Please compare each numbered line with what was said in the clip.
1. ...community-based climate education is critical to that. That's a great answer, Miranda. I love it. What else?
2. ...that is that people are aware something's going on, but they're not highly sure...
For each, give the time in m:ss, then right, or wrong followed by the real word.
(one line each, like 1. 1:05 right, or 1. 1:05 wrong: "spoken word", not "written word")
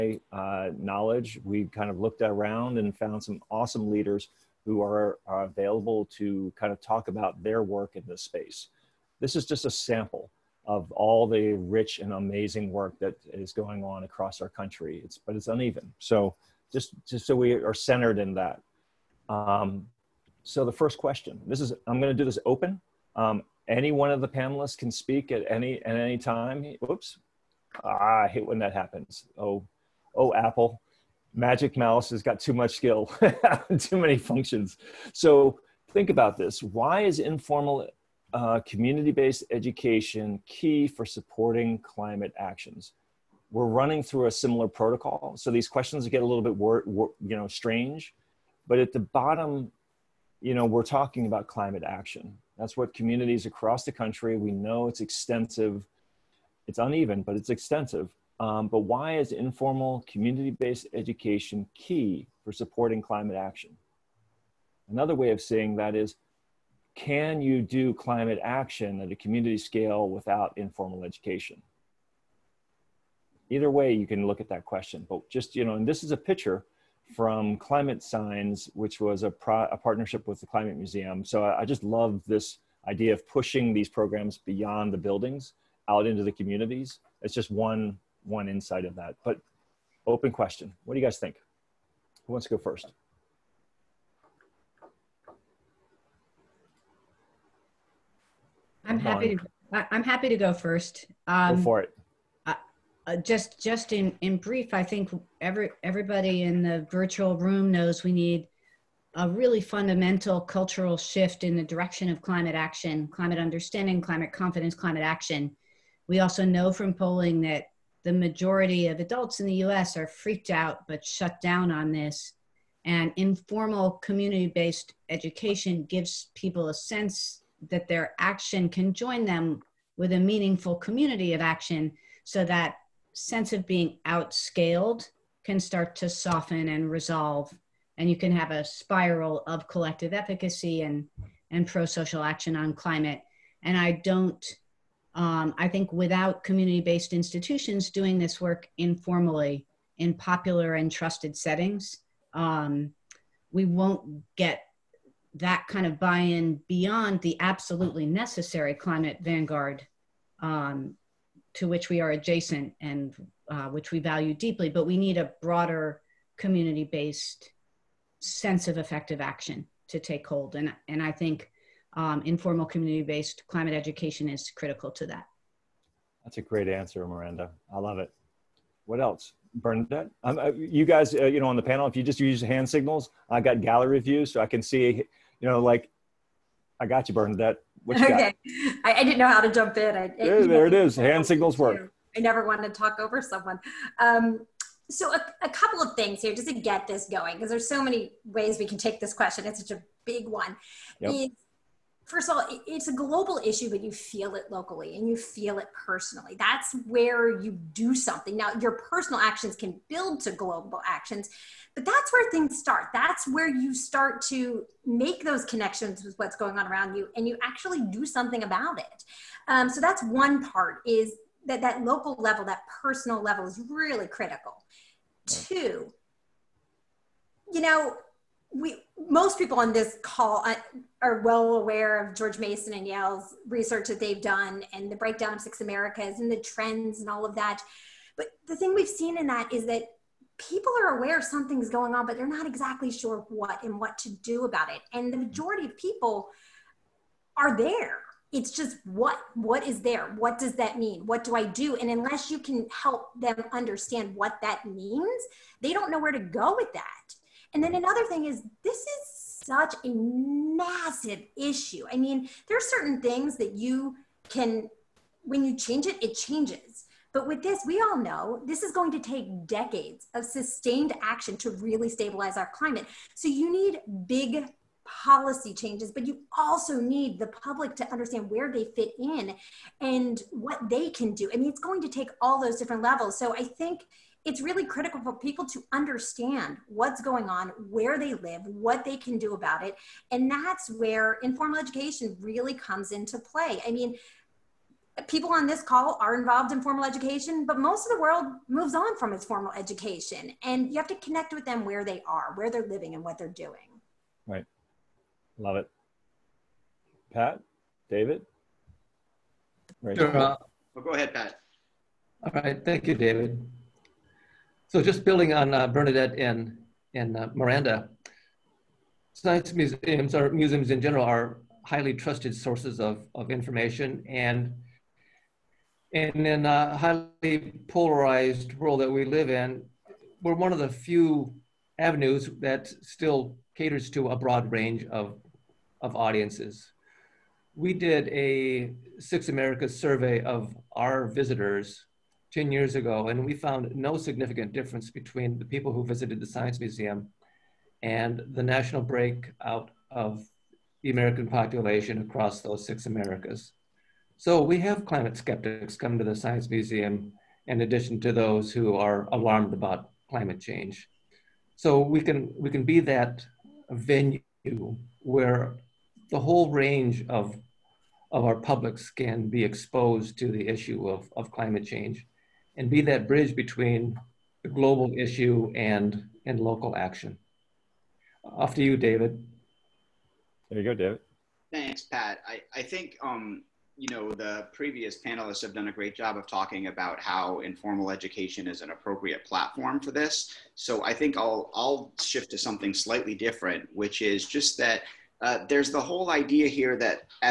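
1. 2:52 right
2. 3:59 wrong: "exactly", not "highly".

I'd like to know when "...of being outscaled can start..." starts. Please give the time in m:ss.
2:13.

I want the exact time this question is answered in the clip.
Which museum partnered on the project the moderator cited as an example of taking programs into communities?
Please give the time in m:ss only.
1:20.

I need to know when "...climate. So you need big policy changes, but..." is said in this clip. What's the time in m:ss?
4:32.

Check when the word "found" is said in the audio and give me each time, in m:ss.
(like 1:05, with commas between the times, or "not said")
0:02, 5:43.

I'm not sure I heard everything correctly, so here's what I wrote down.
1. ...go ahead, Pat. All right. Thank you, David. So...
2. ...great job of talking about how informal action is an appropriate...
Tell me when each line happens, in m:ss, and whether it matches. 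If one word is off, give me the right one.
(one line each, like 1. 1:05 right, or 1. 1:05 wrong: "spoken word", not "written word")
1. 5:10 right
2. 6:25 wrong: "education", not "action".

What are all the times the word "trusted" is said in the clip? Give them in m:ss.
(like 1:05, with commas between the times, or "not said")
2:30, 5:21.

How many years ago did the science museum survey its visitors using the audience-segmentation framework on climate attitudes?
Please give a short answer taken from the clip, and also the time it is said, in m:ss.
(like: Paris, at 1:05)
10, at 5:42.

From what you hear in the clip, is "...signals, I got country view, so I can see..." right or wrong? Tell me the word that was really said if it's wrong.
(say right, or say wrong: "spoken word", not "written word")
wrong: "gallery", not "country".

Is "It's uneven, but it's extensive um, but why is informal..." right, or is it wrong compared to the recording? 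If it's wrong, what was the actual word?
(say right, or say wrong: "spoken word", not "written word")
right.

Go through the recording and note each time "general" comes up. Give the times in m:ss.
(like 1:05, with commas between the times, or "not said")
5:20.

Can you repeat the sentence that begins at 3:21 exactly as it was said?
is first of all, it's a global issue, but you feel it locally and you feel it personally.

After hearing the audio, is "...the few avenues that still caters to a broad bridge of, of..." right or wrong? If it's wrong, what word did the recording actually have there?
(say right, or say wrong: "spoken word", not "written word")
wrong: "range", not "bridge".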